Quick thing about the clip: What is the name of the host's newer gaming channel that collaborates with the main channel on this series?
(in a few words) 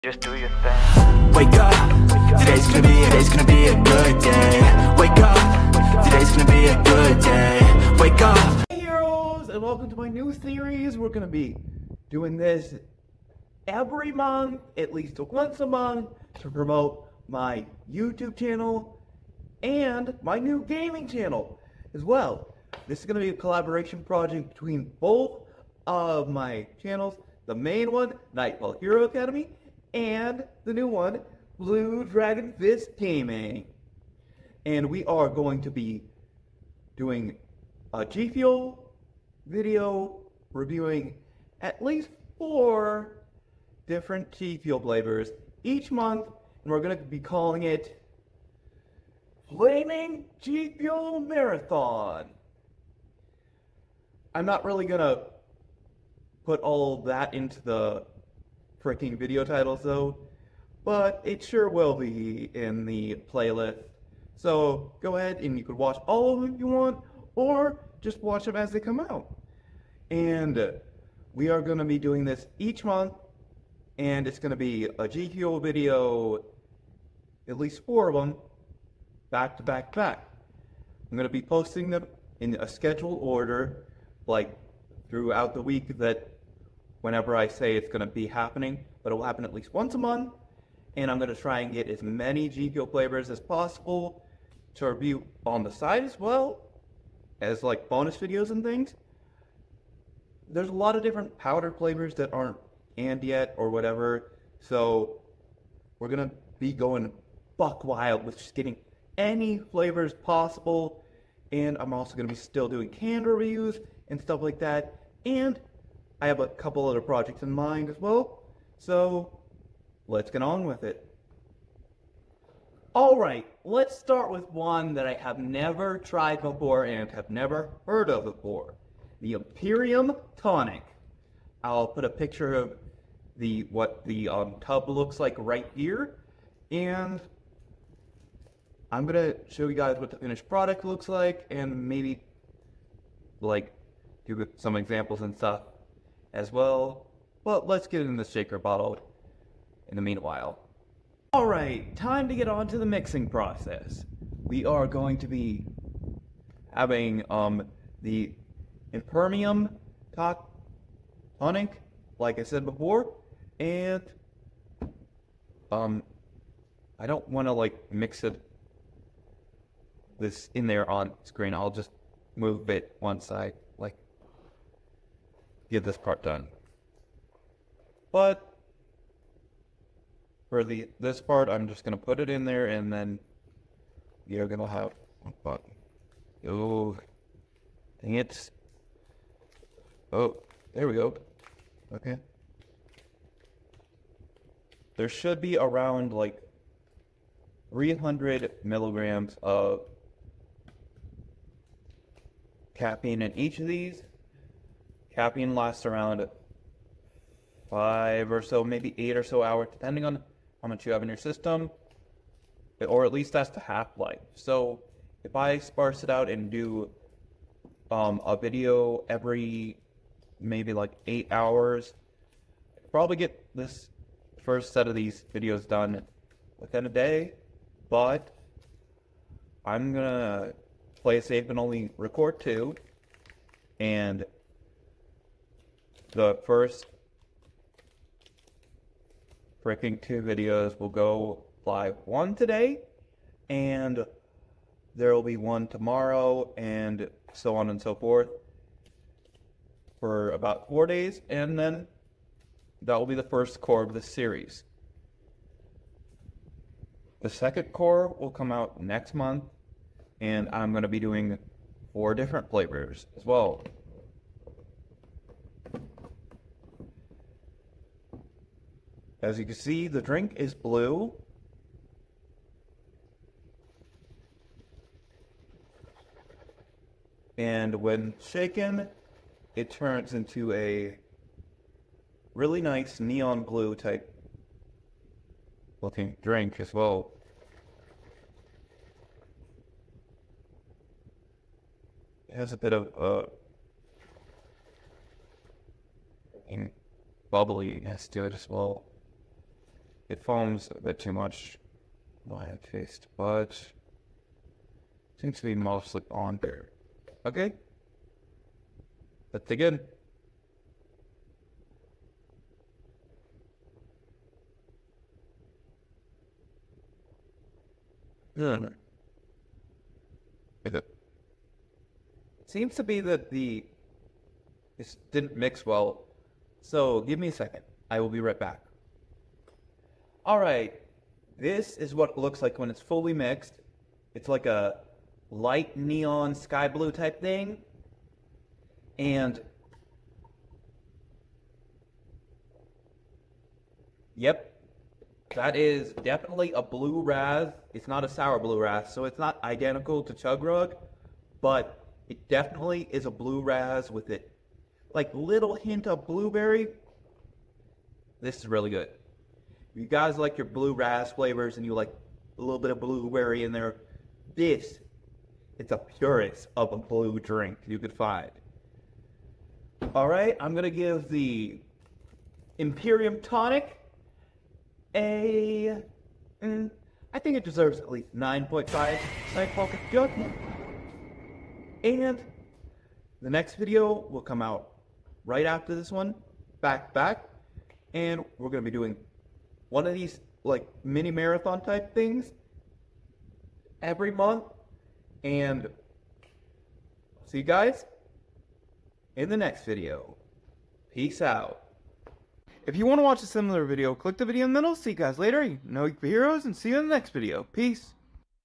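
Blue Dragon Fist Gaming.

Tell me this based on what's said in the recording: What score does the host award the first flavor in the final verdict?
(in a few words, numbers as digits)
9.5.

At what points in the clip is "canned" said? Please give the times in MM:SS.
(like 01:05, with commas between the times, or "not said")
01:52.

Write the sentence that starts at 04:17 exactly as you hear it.
The second core will come out next month, and I'm going to be doing four different flavors as well.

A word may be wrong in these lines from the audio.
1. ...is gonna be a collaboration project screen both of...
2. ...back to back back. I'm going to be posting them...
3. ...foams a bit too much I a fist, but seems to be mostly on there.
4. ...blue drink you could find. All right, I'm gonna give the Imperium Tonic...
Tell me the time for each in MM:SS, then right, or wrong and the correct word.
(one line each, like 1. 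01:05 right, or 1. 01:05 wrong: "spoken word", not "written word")
1. 00:23 wrong: "between", not "screen"
2. 01:19 right
3. 05:00 right
4. 06:06 right.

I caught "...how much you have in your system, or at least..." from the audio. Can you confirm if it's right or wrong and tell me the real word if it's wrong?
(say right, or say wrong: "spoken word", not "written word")
right.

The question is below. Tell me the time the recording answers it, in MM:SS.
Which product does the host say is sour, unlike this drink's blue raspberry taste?
05:50.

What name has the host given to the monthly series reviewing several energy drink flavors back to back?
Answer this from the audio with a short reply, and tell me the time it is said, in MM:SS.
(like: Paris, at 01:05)
Flaming G Fuel Marathon, at 00:49.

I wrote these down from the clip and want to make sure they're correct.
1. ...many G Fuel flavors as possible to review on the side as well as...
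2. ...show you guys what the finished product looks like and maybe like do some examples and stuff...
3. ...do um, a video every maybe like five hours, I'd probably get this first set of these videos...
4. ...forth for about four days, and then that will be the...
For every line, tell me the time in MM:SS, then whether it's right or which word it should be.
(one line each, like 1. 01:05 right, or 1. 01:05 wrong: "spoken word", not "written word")
1. 01:32 right
2. 02:19 right
3. 03:36 wrong: "eight", not "five"
4. 04:07 right.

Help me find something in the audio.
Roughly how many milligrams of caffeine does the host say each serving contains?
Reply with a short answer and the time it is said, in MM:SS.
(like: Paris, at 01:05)
300, at 03:17.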